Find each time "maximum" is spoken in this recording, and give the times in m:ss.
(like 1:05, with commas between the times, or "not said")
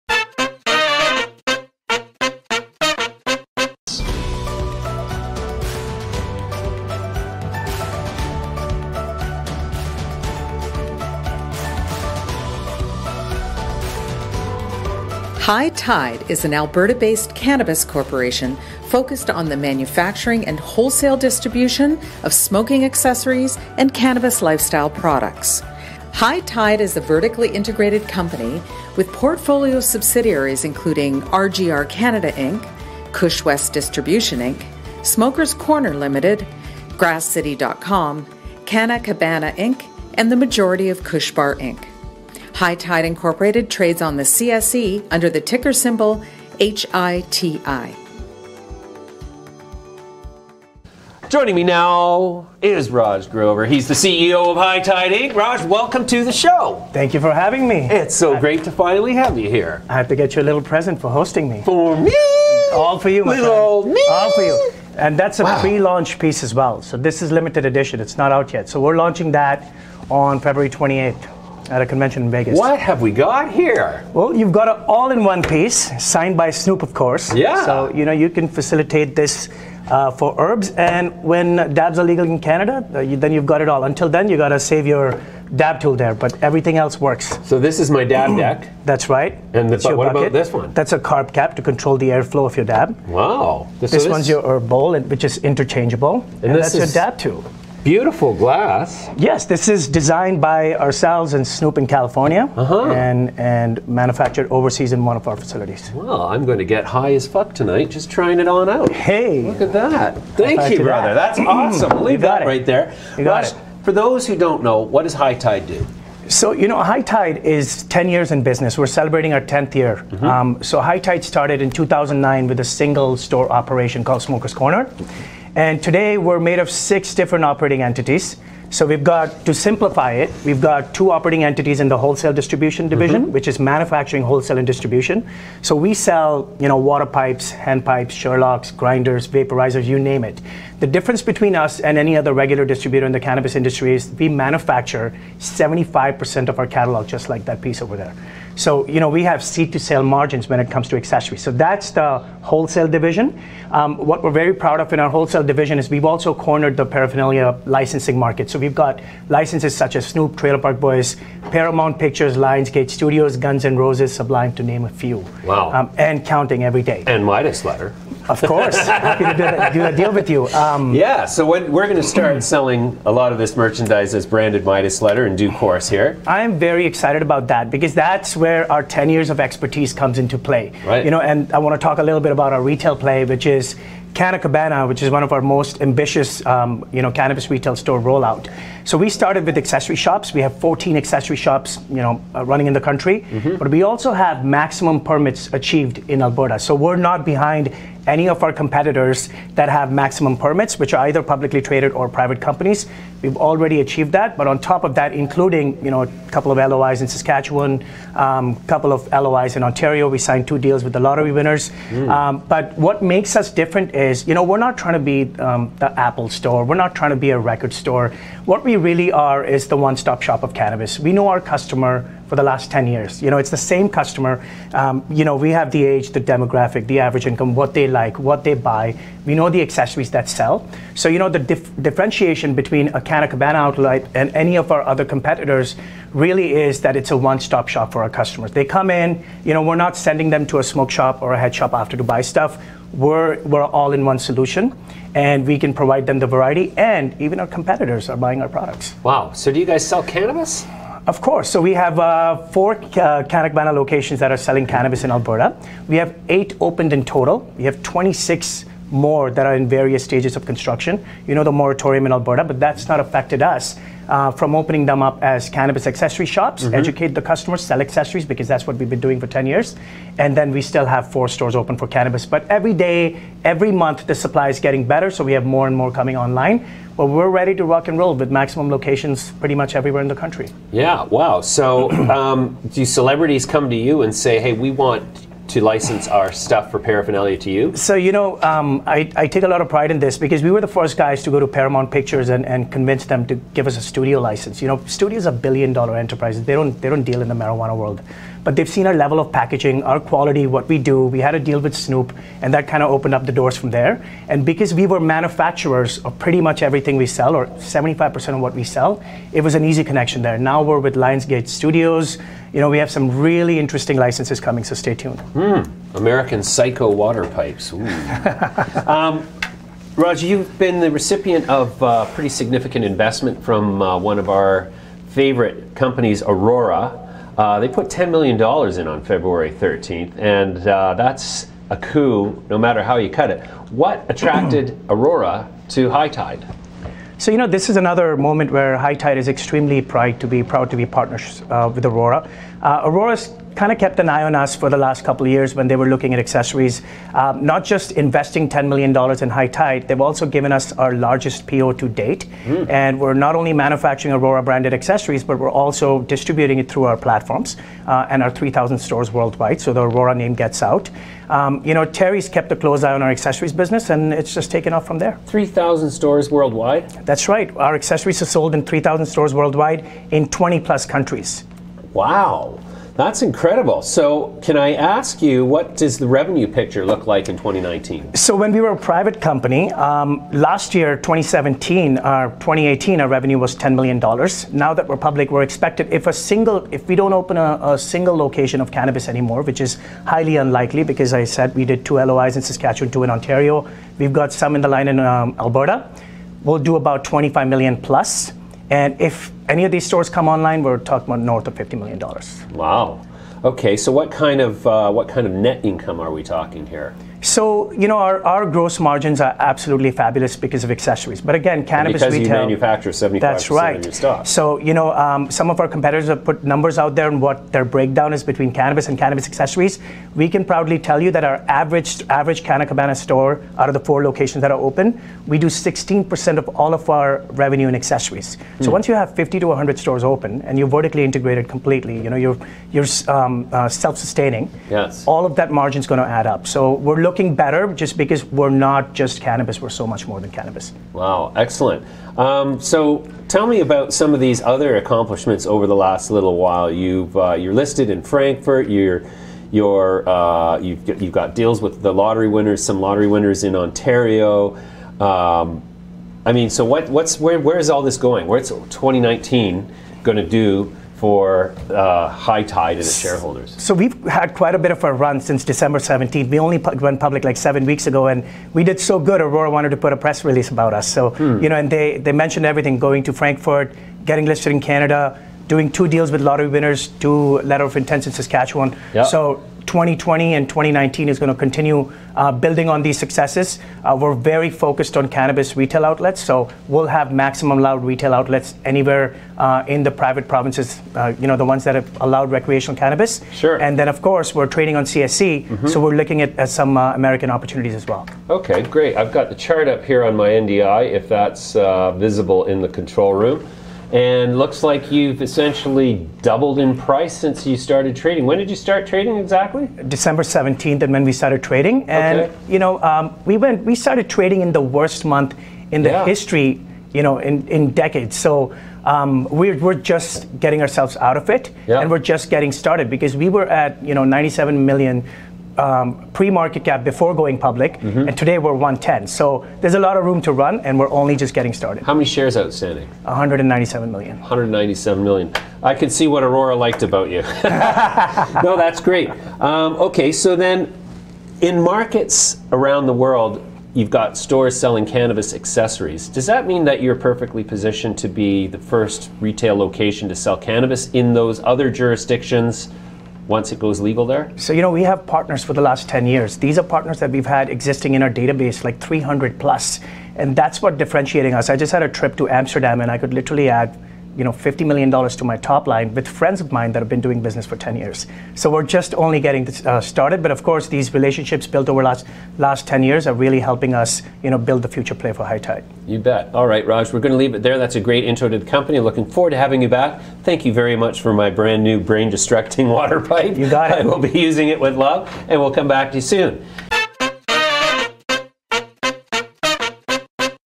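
3:14, 3:19, 4:38, 8:07.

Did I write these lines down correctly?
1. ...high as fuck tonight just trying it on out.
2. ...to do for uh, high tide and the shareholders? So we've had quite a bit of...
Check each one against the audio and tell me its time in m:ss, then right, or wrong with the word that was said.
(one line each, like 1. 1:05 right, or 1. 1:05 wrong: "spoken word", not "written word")
1. 1:46 right
2. 7:40 right.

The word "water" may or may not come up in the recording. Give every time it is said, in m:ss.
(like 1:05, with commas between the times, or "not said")
2:16, 5:16, 9:42.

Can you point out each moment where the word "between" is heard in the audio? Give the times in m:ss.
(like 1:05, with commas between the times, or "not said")
2:21, 3:52, 6:58.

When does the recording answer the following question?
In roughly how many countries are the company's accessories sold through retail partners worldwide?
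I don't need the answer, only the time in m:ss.
6:10.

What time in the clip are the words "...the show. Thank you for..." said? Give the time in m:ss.
0:56.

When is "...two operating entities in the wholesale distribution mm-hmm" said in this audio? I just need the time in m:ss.
2:10.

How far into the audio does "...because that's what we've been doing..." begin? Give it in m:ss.
4:28.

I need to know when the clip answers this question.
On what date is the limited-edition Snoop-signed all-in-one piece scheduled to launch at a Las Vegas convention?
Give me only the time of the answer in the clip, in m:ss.
1:10.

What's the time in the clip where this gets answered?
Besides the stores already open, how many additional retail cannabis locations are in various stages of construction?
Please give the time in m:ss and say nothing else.
4:17.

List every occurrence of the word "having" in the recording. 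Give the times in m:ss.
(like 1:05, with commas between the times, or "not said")
0:57, 9:39.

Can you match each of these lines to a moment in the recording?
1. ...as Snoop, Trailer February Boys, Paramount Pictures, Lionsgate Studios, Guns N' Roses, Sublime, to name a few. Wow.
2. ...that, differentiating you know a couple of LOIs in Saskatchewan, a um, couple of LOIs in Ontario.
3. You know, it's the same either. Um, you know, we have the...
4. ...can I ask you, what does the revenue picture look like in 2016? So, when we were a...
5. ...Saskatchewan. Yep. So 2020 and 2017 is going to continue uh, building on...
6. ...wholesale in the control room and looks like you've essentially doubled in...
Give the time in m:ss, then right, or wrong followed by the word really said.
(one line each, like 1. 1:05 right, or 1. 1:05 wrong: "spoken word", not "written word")
1. 2:39 wrong: "Park", not "February"
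2. 3:24 wrong: "including", not "differentiating"
3. 3:43 wrong: "customer", not "either"
4. 6:14 wrong: "2019", not "2016"
5. 7:58 wrong: "2019", not "2017"
6. 8:21 wrong: "visible", not "wholesale".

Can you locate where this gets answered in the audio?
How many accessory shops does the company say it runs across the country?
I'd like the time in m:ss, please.
3:10.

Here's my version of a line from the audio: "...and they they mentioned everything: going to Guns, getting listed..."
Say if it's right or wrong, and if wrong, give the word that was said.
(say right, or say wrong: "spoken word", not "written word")
wrong: "Frankfurt", not "Guns".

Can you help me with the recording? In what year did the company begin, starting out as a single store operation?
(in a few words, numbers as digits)
2009.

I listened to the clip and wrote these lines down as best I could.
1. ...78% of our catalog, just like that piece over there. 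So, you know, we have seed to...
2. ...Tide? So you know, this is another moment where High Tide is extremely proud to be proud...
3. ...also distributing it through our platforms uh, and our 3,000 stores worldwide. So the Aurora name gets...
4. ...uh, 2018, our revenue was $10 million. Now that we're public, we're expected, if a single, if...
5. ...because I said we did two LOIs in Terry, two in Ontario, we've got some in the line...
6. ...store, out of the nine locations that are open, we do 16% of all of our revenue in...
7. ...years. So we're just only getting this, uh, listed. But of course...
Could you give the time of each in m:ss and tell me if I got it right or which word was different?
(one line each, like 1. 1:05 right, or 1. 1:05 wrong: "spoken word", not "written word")
1. 2:25 wrong: "75", not "78"
2. 5:36 right
3. 5:55 right
4. 6:22 right
5. 6:30 wrong: "Saskatchewan", not "Terry"
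6. 7:02 wrong: "four", not "nine"
7. 9:27 wrong: "started", not "listed".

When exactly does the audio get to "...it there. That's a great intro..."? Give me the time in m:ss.
9:37.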